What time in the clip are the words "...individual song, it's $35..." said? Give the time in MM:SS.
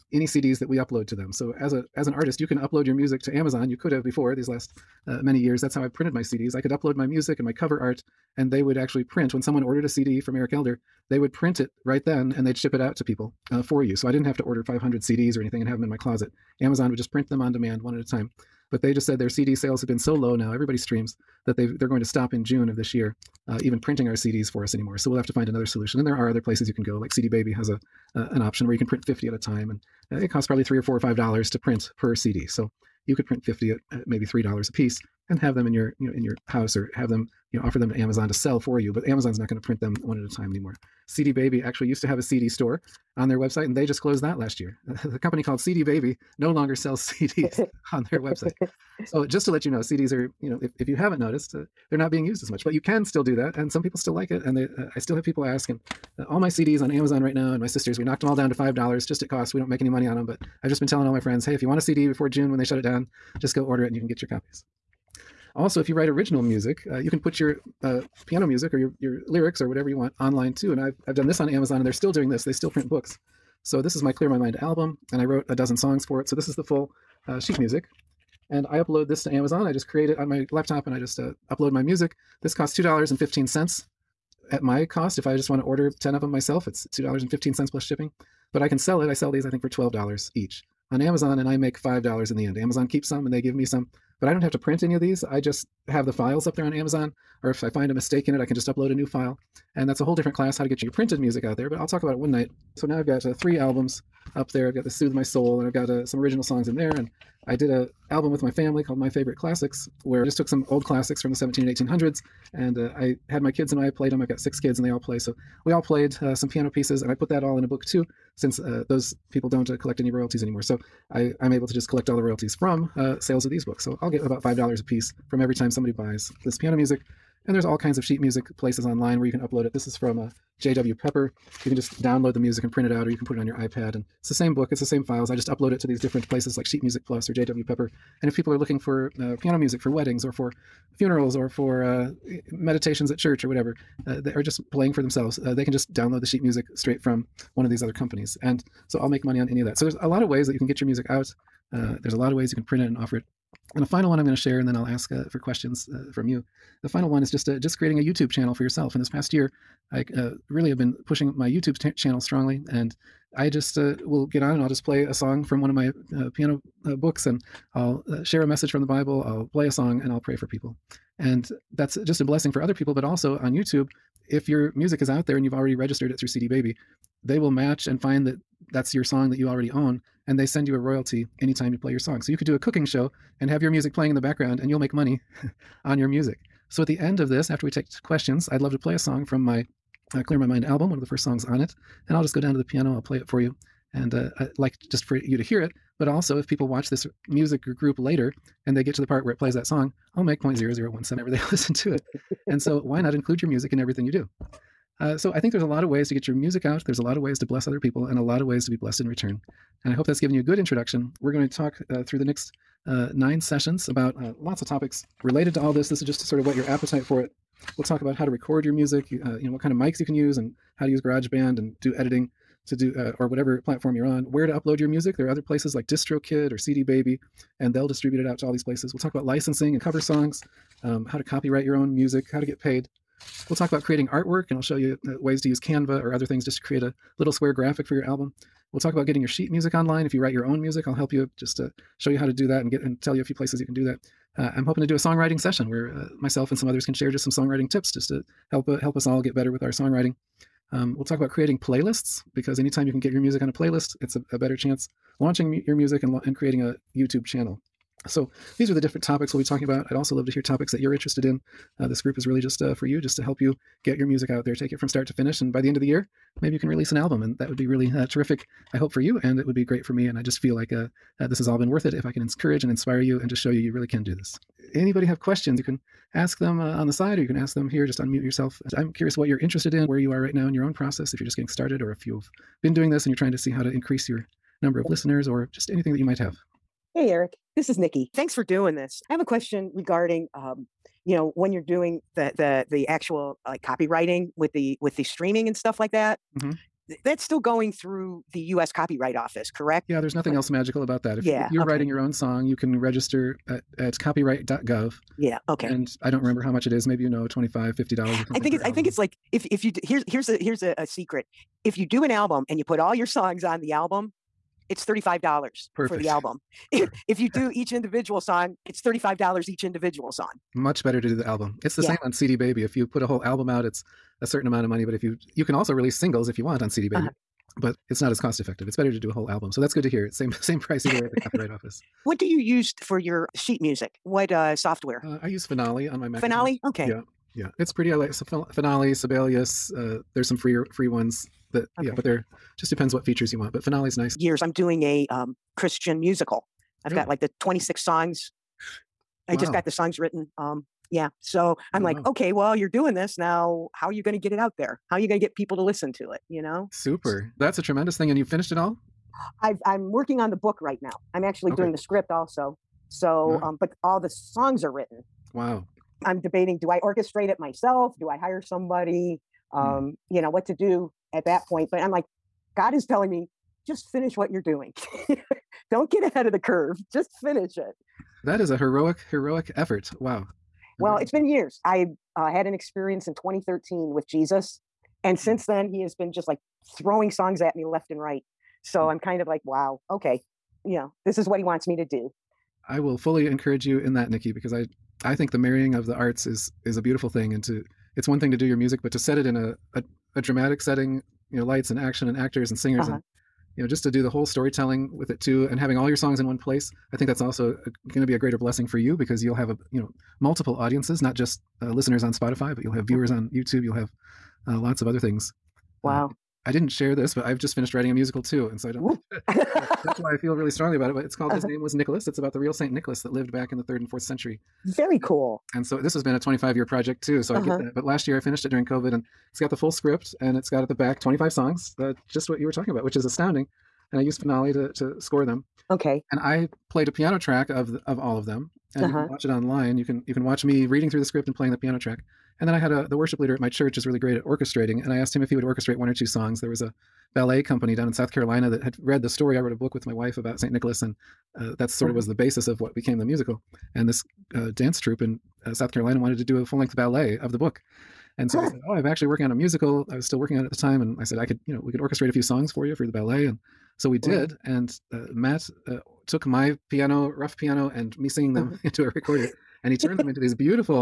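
05:17.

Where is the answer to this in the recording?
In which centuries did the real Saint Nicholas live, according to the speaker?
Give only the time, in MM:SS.
07:03.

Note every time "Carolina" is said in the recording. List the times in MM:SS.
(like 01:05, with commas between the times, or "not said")
07:28, 07:35.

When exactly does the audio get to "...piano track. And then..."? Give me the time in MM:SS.
07:21.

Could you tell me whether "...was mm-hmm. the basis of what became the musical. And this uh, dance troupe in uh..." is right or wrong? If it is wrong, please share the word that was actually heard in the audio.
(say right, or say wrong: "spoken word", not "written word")
right.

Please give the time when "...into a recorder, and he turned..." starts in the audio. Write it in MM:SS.
07:48.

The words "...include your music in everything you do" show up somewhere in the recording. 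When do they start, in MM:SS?
03:23.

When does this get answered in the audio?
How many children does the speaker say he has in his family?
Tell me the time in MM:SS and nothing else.
01:54.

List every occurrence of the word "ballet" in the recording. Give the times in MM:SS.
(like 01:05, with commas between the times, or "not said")
07:27, 07:36, 07:42.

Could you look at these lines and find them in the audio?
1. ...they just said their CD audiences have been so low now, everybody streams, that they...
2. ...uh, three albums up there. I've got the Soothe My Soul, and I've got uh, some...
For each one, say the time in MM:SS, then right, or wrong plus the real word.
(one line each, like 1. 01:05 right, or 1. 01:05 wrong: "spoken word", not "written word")
1. 00:18 wrong: "sales", not "audiences"
2. 01:43 right.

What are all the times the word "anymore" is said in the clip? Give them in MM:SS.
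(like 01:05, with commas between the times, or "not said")
00:24, 00:40, 02:00.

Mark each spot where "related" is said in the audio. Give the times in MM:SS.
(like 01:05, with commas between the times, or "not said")
03:35.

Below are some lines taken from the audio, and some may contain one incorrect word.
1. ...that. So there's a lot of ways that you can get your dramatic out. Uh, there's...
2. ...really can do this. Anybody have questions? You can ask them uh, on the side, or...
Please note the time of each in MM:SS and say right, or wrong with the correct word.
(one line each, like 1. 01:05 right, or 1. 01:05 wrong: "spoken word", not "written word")
1. 02:29 wrong: "music", not "dramatic"
2. 04:33 right.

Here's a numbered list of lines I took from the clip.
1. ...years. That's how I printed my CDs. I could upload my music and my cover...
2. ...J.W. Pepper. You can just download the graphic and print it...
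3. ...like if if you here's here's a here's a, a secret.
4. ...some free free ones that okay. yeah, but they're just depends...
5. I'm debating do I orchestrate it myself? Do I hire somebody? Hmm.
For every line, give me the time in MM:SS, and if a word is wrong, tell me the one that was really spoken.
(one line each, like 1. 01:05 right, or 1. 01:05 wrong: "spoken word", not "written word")
1. 00:05 right
2. 02:10 wrong: "music", not "graphic"
3. 05:08 right
4. 05:40 right
5. 06:06 right.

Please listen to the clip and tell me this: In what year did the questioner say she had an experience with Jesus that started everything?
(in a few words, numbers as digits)
2013.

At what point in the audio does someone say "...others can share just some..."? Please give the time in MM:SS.
04:06.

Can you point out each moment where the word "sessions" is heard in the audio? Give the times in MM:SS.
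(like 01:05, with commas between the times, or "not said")
03:33, 04:05.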